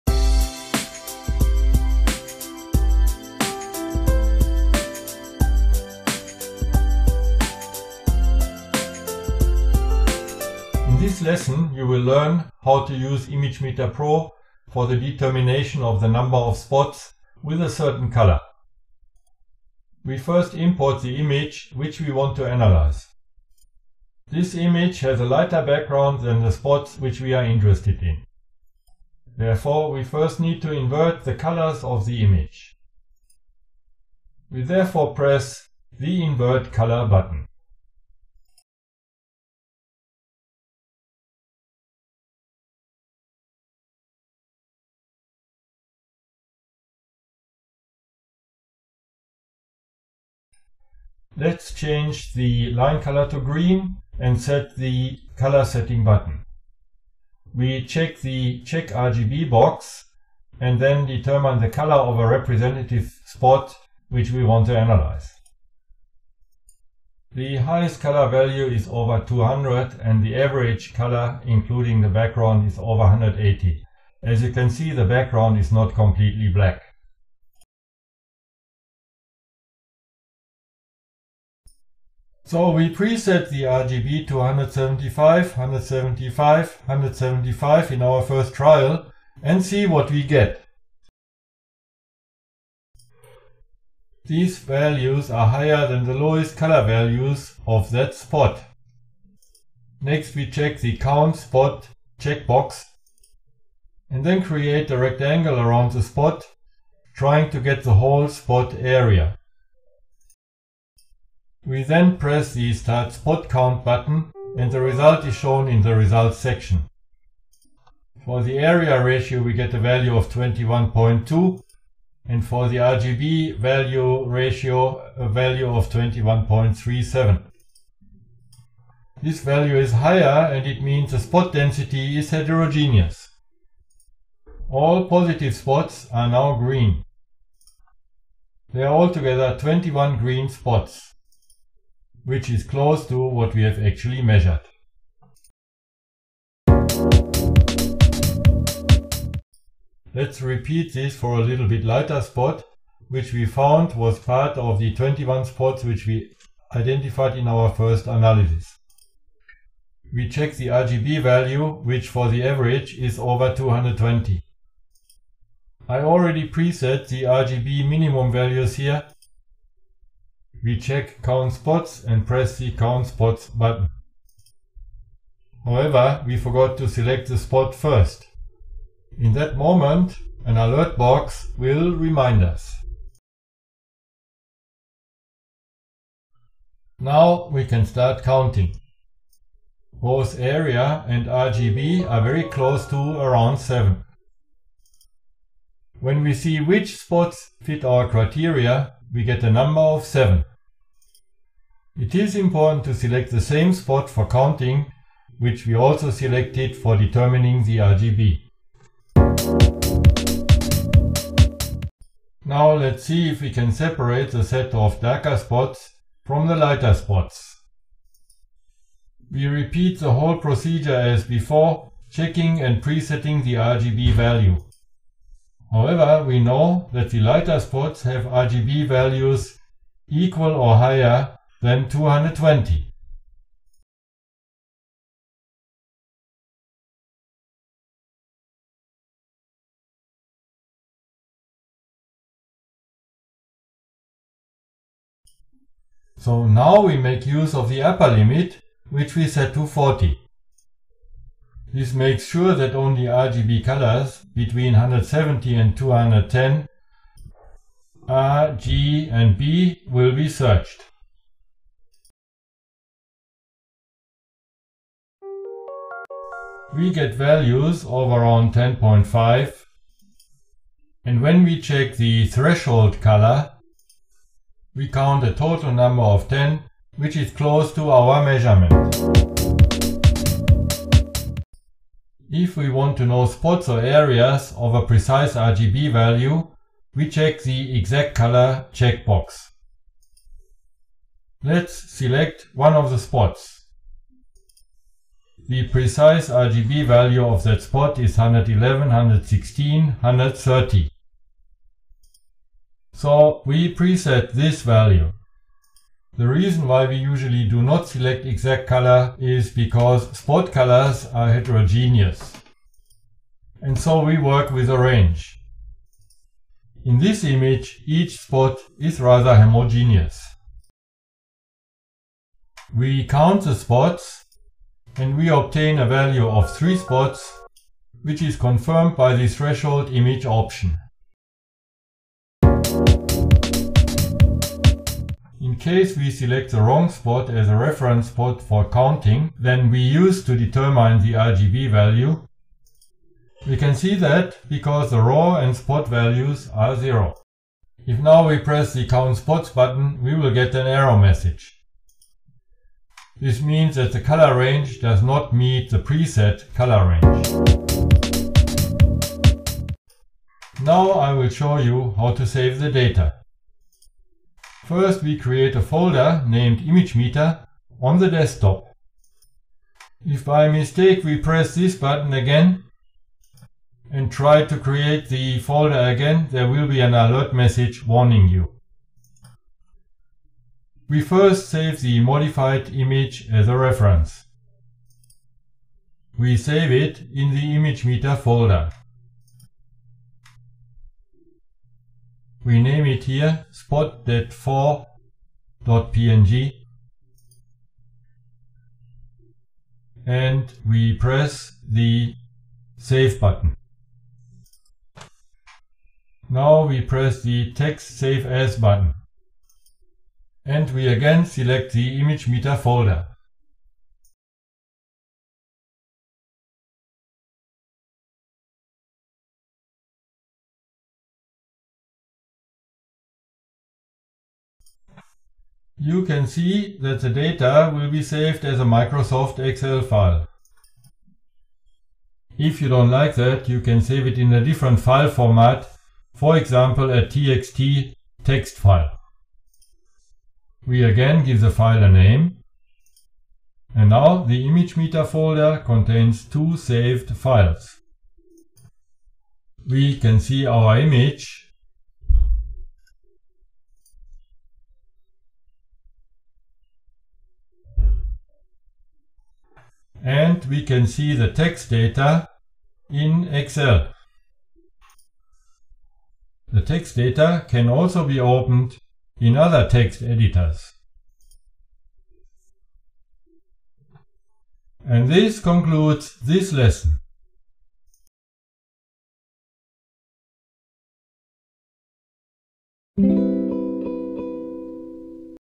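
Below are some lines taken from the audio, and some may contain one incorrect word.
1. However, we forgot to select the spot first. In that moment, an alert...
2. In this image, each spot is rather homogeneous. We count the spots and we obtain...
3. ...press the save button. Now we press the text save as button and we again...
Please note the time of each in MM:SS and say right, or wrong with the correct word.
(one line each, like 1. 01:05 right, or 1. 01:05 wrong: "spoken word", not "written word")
1. 02:55 right
2. 05:16 right
3. 06:40 right.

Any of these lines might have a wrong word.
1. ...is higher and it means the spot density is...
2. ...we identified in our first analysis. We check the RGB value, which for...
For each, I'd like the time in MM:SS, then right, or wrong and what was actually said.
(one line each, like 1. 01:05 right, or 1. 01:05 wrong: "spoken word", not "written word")
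1. 02:09 right
2. 02:36 right.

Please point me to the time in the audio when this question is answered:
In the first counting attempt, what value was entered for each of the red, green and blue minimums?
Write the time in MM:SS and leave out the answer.
01:24.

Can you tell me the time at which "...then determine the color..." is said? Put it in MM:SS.
01:00.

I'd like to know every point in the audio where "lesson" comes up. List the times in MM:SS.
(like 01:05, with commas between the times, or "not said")
00:11, 07:56.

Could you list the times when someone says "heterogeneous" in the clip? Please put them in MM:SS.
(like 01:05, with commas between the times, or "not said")
02:12, 05:11.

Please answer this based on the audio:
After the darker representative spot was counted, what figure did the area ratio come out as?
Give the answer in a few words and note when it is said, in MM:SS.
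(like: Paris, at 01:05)
21.2, at 02:00.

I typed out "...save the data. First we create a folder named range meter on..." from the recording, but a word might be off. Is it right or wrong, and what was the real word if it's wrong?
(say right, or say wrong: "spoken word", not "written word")
wrong: "image", not "range".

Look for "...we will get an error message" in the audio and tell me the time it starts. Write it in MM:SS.
05:50.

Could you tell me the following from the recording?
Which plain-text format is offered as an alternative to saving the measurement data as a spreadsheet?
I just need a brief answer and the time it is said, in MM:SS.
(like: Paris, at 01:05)
TXT, at 07:17.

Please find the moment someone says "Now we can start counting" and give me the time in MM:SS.
03:06.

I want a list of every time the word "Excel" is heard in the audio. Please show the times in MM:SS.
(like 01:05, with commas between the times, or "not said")
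07:09, 07:43.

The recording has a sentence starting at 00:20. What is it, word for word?
We first import the image which we want to analyze.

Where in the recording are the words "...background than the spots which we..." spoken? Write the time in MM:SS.
00:25.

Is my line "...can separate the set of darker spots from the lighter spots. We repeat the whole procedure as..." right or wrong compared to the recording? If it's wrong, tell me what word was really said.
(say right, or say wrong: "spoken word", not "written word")
right.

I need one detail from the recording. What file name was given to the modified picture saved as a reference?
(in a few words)
spot.4.png.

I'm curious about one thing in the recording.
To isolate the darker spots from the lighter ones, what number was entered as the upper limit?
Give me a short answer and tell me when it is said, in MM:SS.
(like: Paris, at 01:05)
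40, at 04:09.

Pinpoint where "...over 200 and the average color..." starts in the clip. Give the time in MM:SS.
01:08.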